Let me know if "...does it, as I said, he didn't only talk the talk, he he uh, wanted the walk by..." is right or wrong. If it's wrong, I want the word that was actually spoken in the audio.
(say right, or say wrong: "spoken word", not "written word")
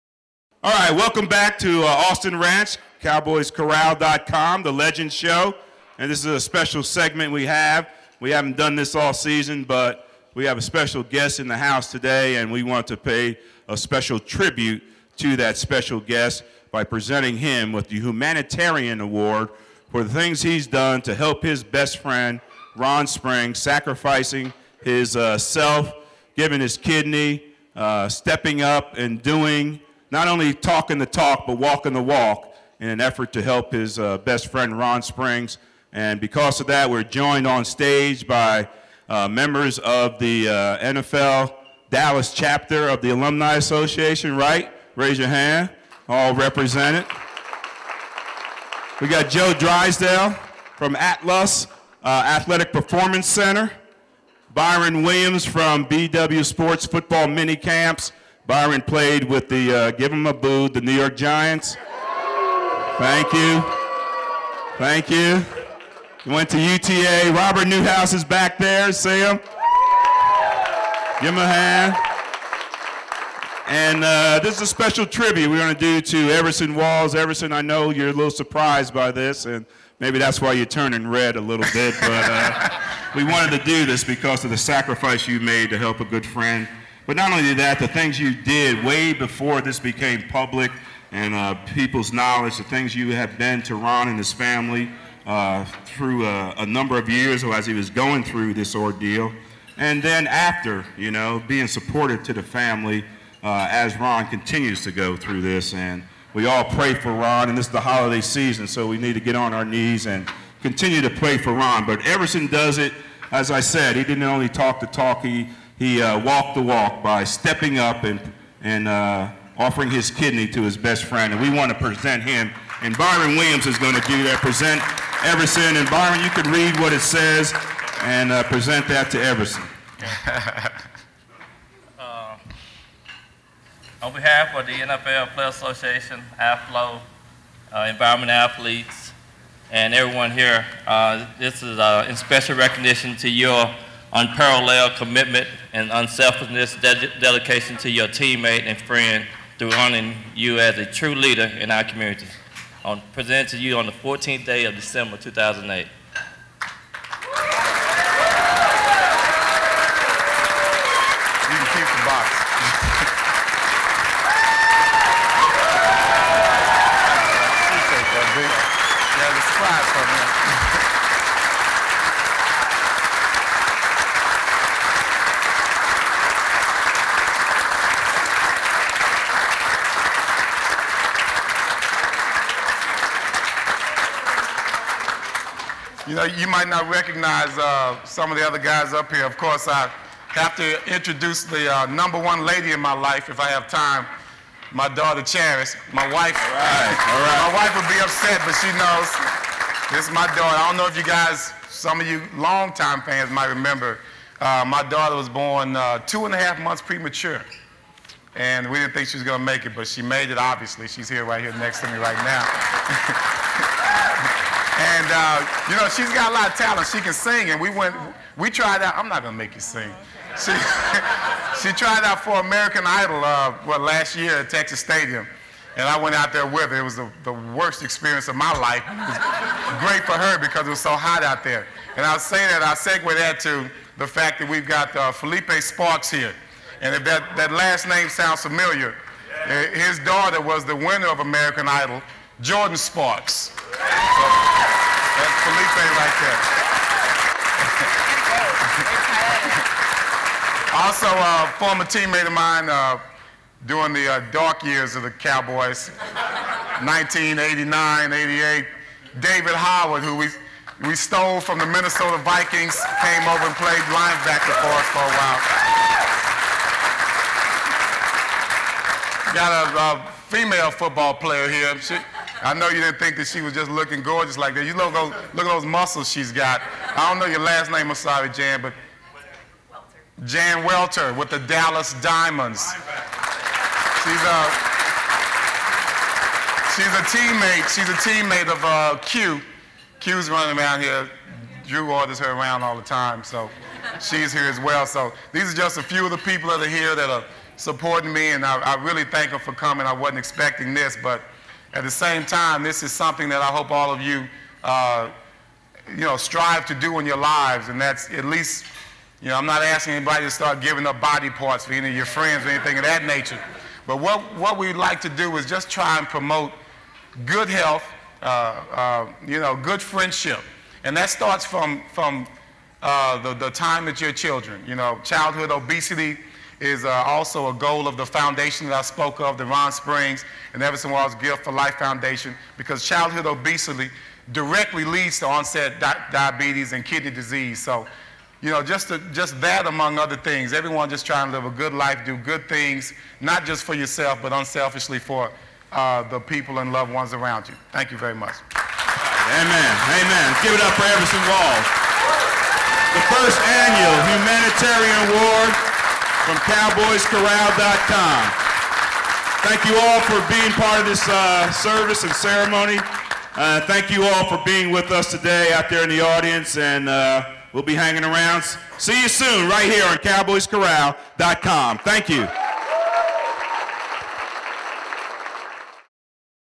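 wrong: "walked", not "wanted".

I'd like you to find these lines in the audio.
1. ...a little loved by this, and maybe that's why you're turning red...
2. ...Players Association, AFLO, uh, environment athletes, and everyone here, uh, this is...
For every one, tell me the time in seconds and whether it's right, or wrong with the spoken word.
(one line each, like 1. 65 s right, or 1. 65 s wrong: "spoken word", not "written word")
1. 78 s wrong: "surprised", not "loved"
2. 135 s right.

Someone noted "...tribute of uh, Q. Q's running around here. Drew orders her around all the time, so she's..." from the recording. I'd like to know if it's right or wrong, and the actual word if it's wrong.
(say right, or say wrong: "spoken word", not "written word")
wrong: "teammate", not "tribute".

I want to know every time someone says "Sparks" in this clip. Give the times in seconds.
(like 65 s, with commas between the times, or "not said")
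235 s, 242 s.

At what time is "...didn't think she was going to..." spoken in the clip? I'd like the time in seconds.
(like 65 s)
208 s.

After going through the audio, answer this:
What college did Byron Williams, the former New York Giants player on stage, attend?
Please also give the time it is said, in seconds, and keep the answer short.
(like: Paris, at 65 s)
UTA, at 66 s.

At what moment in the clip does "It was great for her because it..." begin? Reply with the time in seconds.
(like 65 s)
228 s.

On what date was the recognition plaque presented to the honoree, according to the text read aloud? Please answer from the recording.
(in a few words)
December 14, 2008.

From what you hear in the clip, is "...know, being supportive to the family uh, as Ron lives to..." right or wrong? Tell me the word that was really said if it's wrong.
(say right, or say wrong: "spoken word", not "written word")
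wrong: "continues", not "lives".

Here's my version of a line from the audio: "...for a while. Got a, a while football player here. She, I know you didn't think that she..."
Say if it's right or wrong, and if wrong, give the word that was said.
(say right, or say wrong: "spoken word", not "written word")
wrong: "female", not "while".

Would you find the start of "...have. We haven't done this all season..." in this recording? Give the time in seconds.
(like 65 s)
7 s.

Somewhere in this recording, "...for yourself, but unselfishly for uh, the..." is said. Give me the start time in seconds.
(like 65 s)
343 s.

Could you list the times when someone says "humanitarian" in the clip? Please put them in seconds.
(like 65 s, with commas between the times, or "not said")
17 s, 354 s.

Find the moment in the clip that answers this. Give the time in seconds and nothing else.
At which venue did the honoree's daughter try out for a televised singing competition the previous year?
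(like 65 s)
224 s.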